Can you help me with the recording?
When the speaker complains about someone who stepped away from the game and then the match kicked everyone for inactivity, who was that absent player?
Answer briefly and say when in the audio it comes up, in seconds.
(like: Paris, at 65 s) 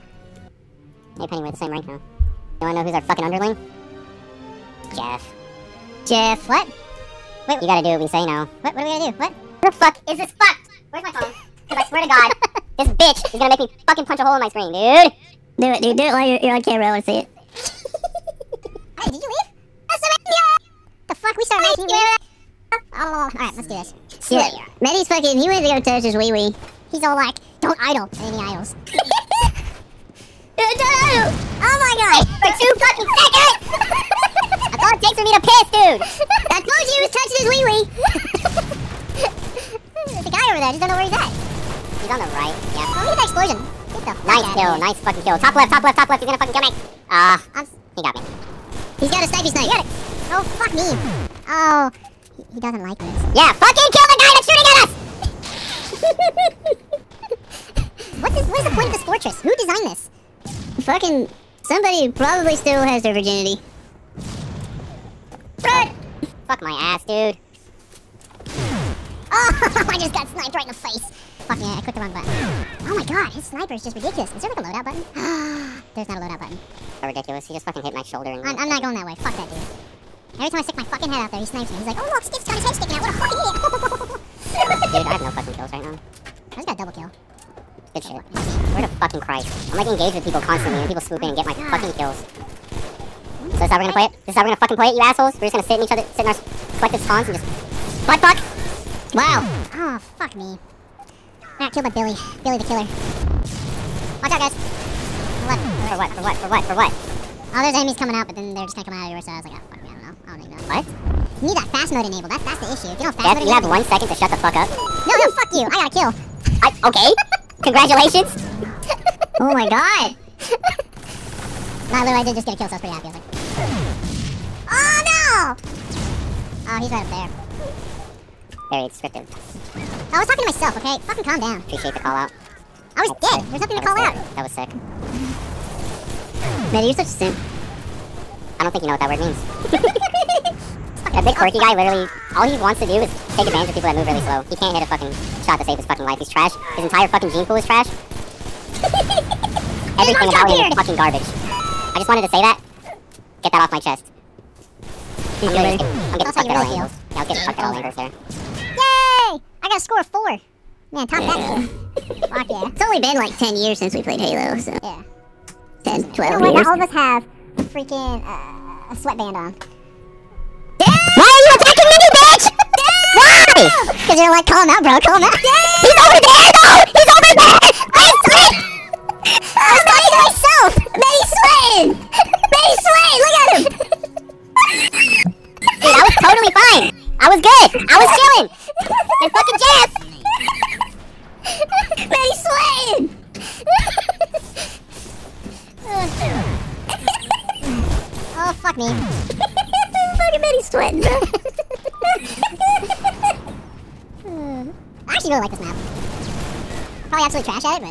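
Manny, at 24 s.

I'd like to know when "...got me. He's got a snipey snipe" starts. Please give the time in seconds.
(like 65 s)
48 s.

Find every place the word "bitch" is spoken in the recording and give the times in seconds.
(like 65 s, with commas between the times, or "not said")
12 s, 172 s.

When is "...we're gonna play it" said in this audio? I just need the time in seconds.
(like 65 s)
93 s.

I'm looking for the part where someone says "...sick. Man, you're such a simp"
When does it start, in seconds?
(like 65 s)
134 s.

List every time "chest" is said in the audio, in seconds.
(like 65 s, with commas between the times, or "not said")
153 s.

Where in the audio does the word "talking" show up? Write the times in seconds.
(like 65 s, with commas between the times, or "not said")
130 s, 179 s.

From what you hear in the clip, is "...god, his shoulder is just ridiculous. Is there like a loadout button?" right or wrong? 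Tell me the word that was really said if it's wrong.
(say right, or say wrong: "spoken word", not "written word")
wrong: "sniper", not "shoulder".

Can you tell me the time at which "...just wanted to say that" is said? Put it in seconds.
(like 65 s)
151 s.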